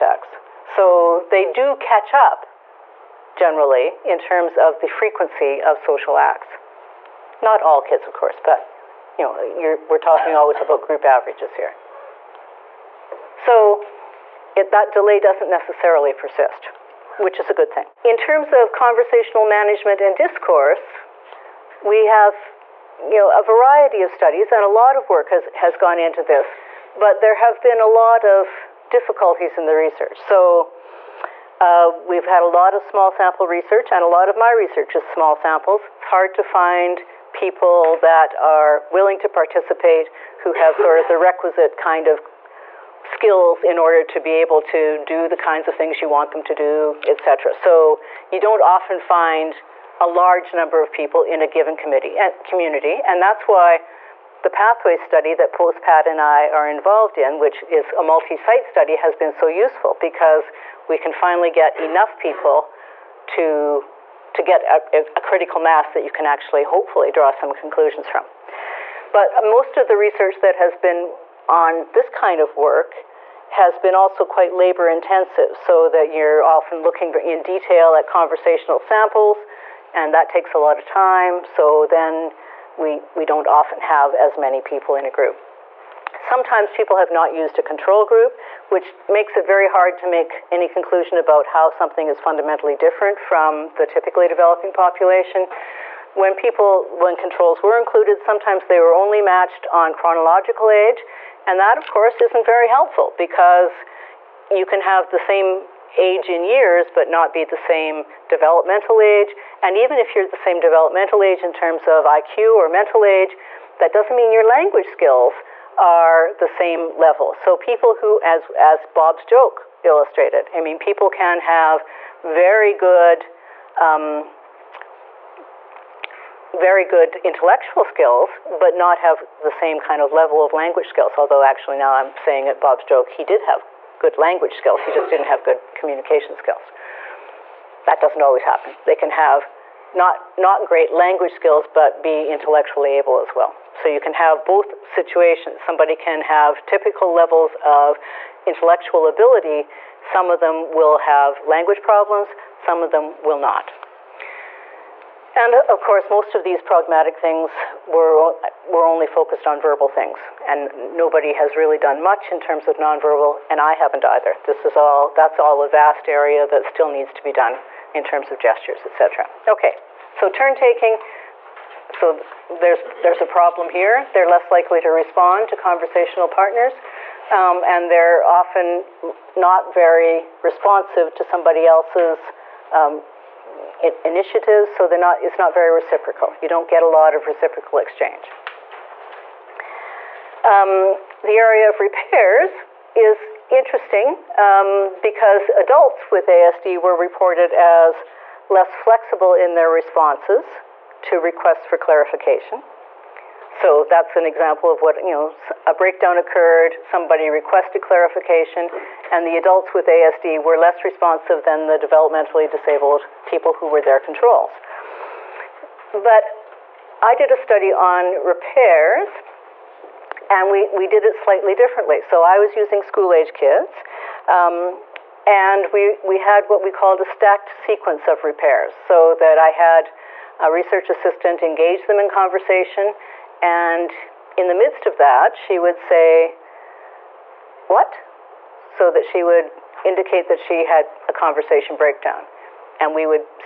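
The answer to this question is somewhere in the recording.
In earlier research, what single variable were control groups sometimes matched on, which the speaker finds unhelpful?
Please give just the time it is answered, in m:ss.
1:39.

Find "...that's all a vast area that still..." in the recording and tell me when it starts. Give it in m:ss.
2:45.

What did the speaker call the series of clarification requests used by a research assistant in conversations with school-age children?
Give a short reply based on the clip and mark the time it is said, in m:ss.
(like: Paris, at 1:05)
Stacked sequence of repairs, at 3:47.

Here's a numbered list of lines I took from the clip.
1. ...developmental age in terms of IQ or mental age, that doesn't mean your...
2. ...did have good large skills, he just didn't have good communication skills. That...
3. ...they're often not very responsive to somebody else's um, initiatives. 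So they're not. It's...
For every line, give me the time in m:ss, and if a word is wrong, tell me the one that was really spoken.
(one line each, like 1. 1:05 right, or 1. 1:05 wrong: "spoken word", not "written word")
1. 1:50 right
2. 2:13 wrong: "language", not "large"
3. 2:57 right.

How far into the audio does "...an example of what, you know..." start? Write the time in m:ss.
3:24.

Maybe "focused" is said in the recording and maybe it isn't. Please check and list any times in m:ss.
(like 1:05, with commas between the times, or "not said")
2:39.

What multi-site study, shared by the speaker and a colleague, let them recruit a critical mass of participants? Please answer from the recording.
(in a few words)
Pathway study.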